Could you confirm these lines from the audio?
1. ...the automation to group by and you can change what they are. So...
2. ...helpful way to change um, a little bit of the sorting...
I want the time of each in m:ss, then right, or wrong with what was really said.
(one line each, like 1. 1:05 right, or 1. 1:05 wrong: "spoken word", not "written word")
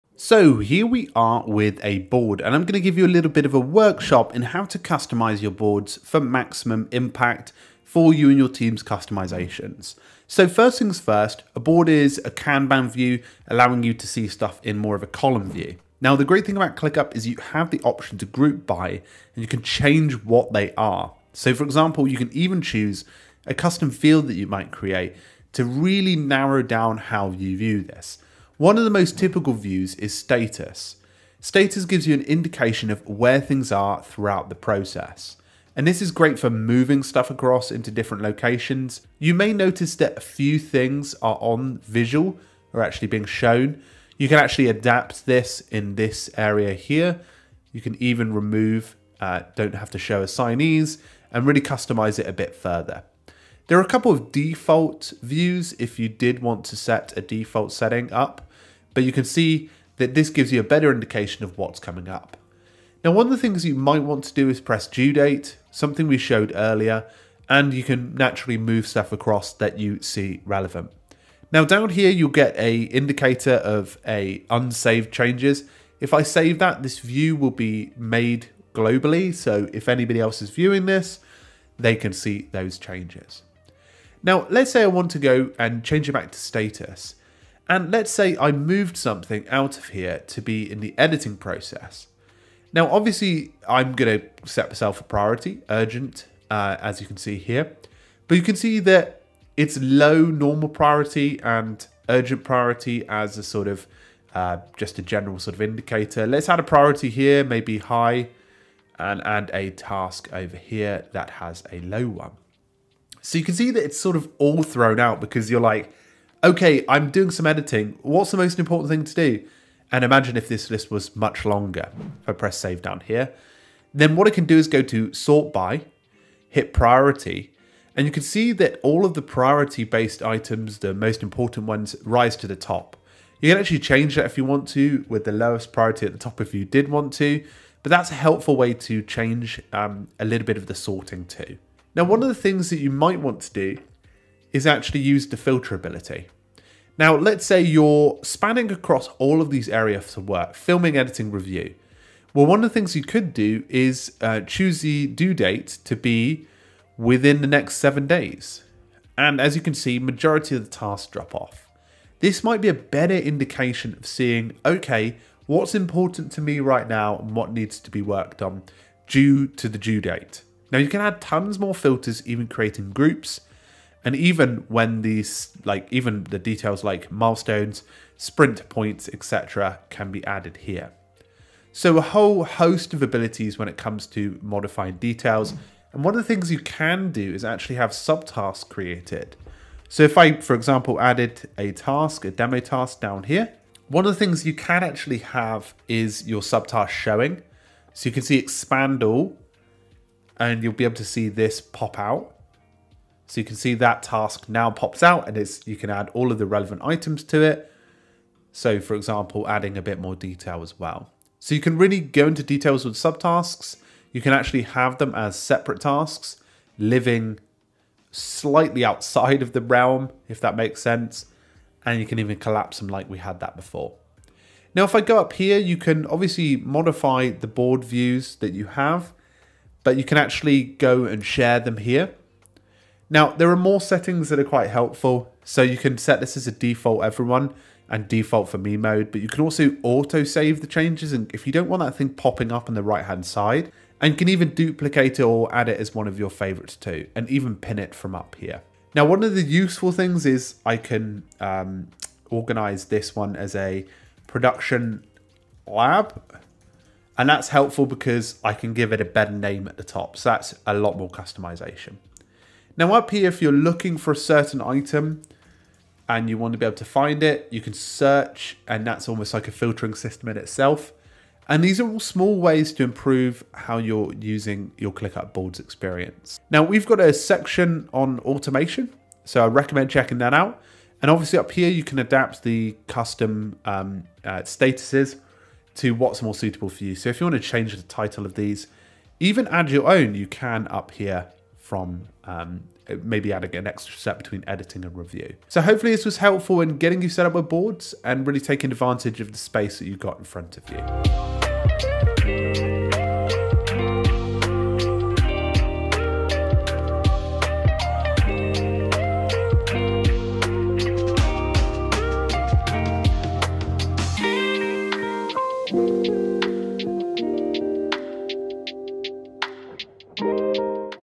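1. 0:17 wrong: "option", not "automation"
2. 2:18 right.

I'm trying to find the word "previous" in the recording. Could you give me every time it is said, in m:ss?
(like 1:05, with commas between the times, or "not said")
not said.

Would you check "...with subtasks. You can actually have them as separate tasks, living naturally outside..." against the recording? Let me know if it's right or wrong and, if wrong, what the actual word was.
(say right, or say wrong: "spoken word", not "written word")
wrong: "slightly", not "naturally".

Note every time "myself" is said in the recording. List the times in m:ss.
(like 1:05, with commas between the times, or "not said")
1:34.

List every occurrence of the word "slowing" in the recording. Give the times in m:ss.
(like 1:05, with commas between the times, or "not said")
not said.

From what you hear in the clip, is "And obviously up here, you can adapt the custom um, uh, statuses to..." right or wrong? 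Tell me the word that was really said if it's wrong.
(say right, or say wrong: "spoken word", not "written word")
right.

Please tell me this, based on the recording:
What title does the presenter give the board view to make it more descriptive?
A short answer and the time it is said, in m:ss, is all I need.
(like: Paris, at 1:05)
production lab, at 4:14.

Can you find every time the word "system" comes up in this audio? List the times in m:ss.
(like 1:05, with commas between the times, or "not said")
4:29.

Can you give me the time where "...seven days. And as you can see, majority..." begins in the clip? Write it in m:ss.
2:37.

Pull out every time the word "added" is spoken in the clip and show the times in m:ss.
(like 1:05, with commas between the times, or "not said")
3:00, 3:11.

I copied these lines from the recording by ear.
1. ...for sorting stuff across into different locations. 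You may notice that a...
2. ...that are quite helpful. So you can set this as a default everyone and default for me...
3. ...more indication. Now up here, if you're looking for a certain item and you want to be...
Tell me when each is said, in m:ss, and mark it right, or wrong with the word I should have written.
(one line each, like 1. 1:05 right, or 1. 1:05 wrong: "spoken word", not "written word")
1. 0:36 wrong: "moving", not "sorting"
2. 3:54 right
3. 4:20 wrong: "customization", not "indication".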